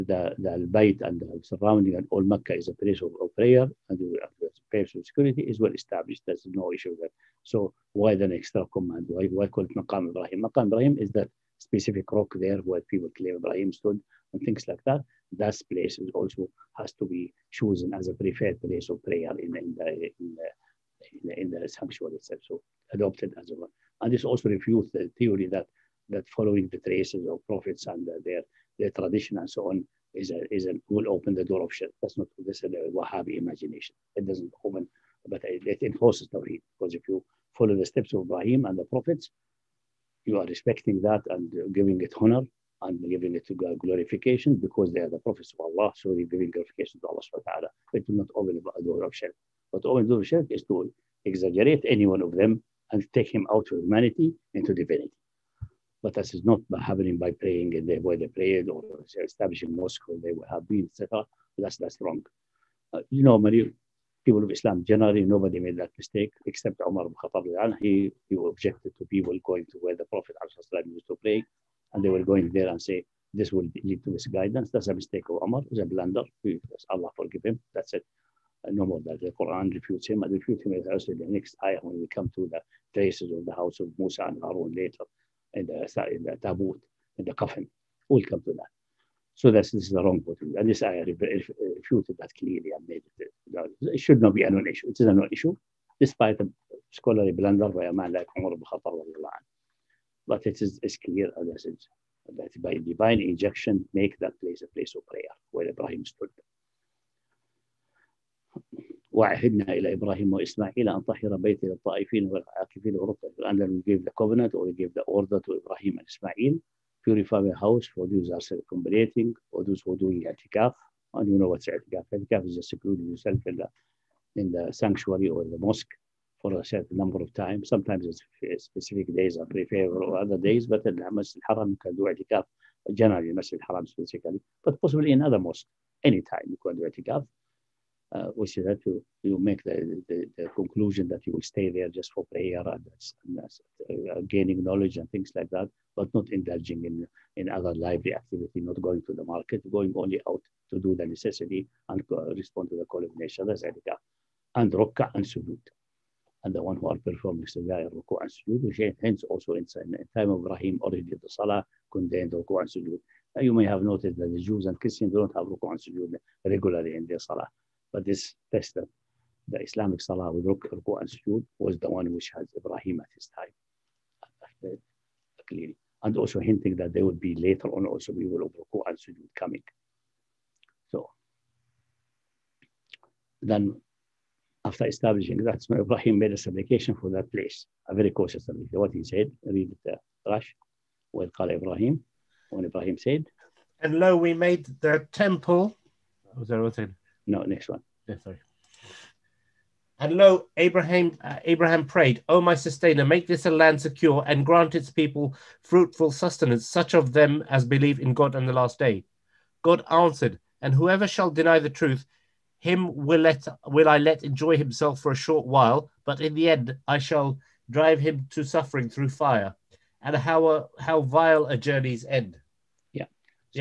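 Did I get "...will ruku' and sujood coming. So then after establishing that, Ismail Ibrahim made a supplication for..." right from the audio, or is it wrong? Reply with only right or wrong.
right.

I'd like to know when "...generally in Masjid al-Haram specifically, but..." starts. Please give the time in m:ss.
2:12.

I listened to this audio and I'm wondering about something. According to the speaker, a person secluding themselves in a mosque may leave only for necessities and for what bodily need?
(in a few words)
call of nature.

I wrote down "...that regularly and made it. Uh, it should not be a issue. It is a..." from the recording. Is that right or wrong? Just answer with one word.
wrong.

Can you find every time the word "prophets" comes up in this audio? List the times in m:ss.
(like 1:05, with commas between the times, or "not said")
0:27, 0:38, 0:45, 1:10.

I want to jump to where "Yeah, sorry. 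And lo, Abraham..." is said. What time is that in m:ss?
3:18.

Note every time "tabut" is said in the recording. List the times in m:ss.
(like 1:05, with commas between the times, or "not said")
1:26.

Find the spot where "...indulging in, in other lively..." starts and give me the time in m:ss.
2:26.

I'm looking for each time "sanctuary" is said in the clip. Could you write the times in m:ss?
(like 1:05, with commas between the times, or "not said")
0:21, 2:04.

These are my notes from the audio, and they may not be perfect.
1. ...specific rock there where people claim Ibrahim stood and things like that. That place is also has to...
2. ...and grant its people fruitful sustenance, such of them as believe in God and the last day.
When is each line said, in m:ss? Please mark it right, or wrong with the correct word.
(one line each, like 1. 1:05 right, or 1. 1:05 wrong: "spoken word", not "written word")
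1. 0:11 right
2. 3:24 right.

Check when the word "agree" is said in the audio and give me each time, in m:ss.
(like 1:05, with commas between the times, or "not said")
not said.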